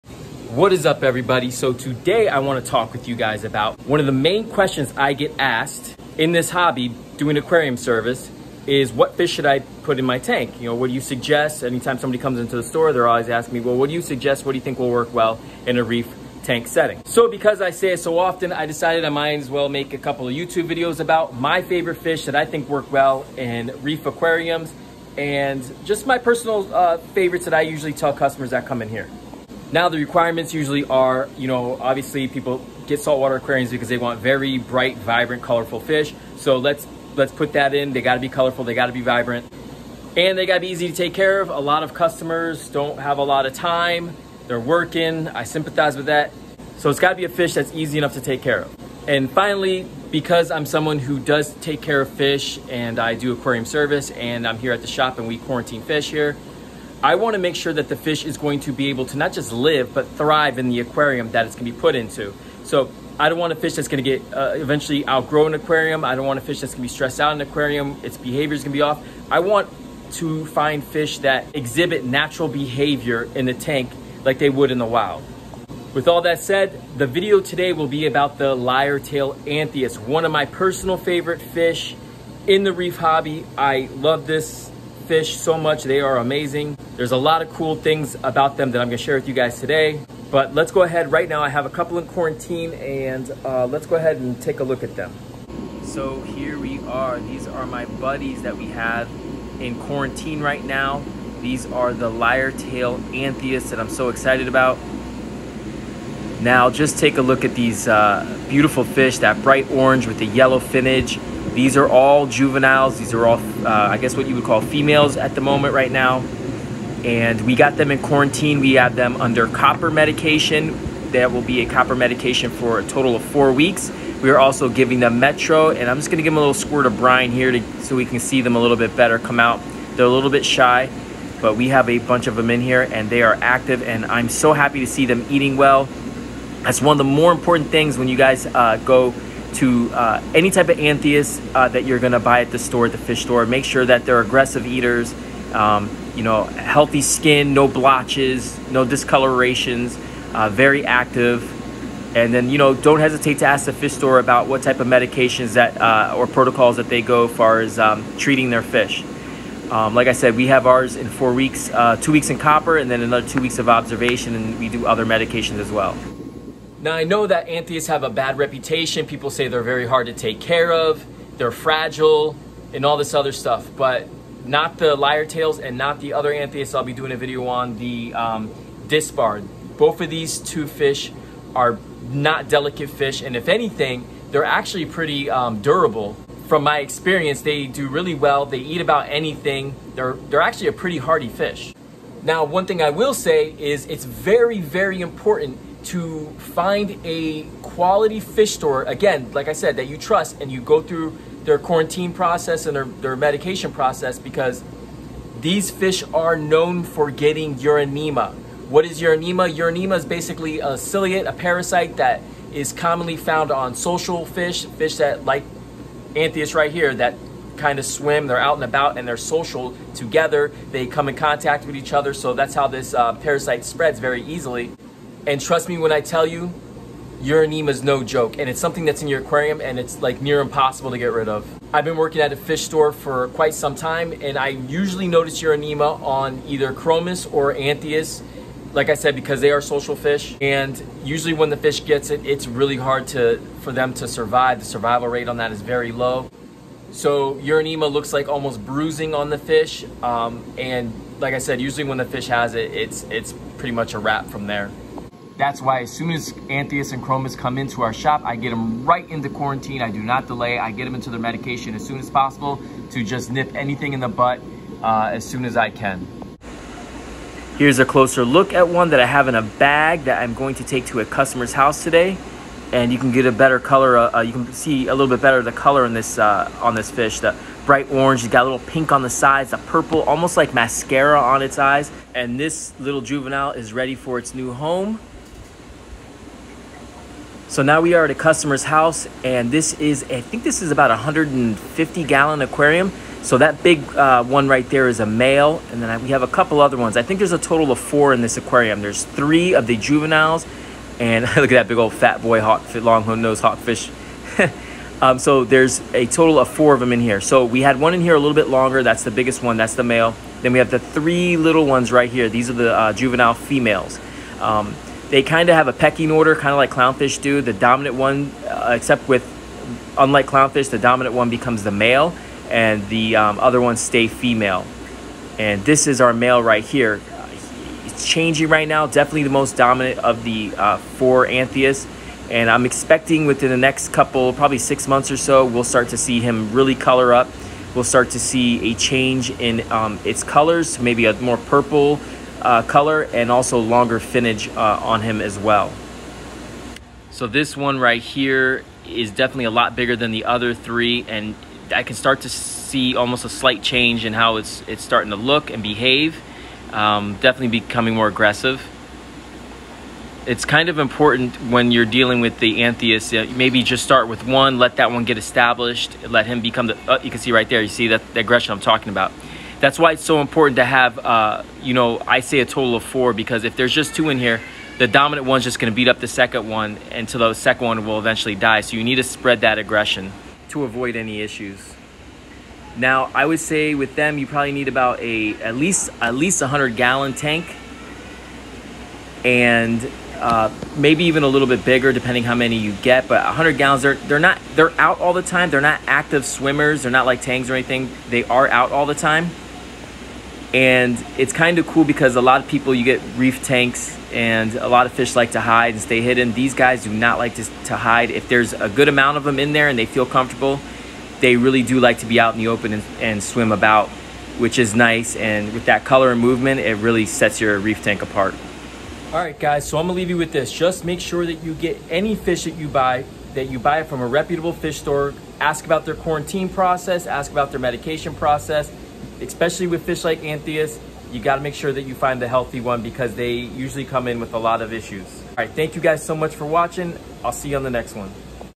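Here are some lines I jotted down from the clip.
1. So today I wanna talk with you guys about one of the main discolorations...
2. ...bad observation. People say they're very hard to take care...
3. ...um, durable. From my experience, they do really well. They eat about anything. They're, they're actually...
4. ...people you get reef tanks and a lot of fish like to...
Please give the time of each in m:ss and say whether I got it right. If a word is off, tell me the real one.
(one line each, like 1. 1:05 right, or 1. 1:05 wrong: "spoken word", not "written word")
1. 0:01 wrong: "questions", not "discolorations"
2. 2:48 wrong: "reputation", not "observation"
3. 3:05 right
4. 6:42 right.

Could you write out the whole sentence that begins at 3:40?
They come in contact with each other, so that's how this uh, parasite spreads very easily.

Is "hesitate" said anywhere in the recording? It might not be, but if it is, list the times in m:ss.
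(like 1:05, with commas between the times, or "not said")
2:32.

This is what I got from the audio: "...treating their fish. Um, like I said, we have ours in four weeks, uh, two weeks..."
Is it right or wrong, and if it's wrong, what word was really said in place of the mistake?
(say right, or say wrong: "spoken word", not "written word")
right.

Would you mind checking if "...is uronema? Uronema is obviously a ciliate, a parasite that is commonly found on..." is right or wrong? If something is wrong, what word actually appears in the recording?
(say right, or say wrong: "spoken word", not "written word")
wrong: "basically", not "obviously".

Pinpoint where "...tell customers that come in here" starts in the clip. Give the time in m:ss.
0:27.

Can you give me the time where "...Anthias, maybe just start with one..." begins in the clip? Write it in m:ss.
6:02.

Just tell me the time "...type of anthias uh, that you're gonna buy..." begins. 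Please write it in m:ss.
2:20.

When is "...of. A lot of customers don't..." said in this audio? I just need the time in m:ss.
0:41.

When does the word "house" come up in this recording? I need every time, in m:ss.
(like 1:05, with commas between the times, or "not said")
4:31, 4:48.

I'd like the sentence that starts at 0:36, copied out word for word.
So let's let's put that in.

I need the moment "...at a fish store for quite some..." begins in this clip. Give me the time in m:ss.
3:52.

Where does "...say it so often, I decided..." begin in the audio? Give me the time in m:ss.
0:17.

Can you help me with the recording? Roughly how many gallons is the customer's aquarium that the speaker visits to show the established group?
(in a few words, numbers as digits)
150 gallons.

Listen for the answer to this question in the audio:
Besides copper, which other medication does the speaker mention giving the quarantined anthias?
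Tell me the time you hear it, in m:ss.
2:05.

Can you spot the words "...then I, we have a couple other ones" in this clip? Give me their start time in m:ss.
4:55.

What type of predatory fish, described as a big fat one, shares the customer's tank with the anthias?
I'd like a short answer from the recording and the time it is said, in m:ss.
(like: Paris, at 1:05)
Long nose hawkfish, at 5:02.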